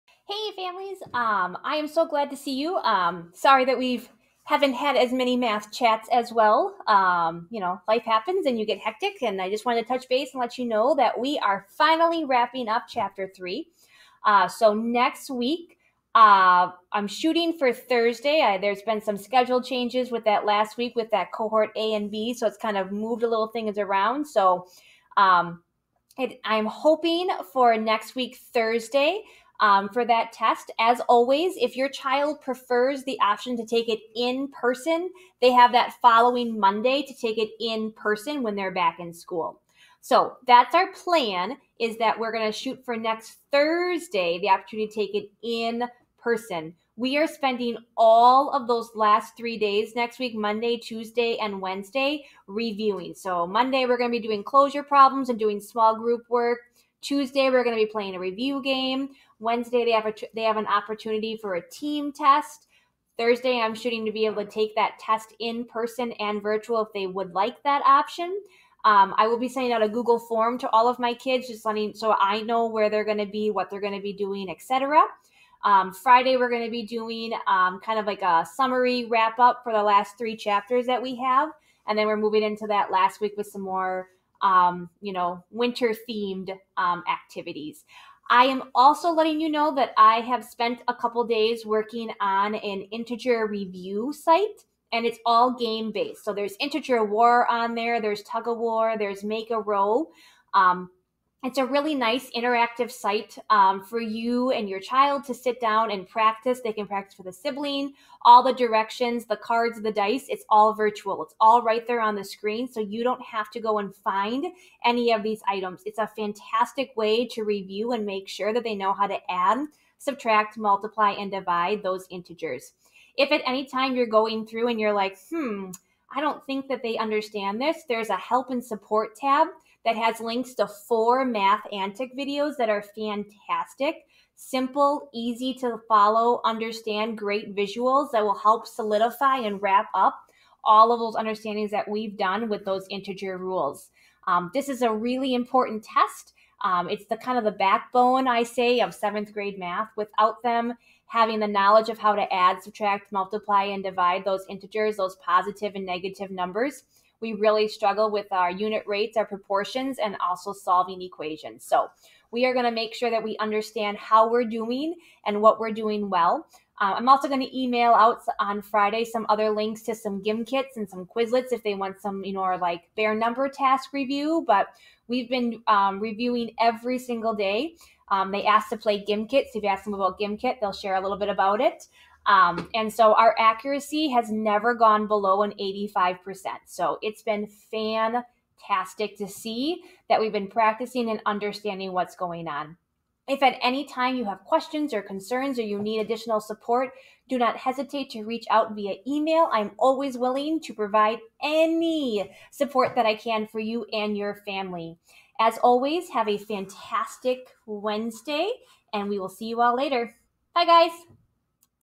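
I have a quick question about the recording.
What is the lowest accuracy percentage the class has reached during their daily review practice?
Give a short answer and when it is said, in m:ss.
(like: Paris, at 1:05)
85%, at 3:05.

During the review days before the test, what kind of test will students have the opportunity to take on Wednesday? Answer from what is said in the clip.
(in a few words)
team test.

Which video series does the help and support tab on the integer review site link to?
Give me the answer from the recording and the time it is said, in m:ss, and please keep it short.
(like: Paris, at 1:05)
Math Antics, at 2:11.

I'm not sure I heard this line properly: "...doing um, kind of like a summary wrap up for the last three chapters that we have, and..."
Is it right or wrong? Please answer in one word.
right.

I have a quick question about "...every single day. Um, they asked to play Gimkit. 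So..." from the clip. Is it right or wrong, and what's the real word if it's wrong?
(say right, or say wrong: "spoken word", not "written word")
right.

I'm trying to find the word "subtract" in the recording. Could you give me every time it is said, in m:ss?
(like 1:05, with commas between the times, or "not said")
1:59, 2:32.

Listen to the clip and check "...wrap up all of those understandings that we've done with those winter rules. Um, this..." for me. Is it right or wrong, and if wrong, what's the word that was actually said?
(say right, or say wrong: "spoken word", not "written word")
wrong: "integer", not "winter".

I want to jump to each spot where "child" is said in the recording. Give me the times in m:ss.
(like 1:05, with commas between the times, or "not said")
0:31, 1:44.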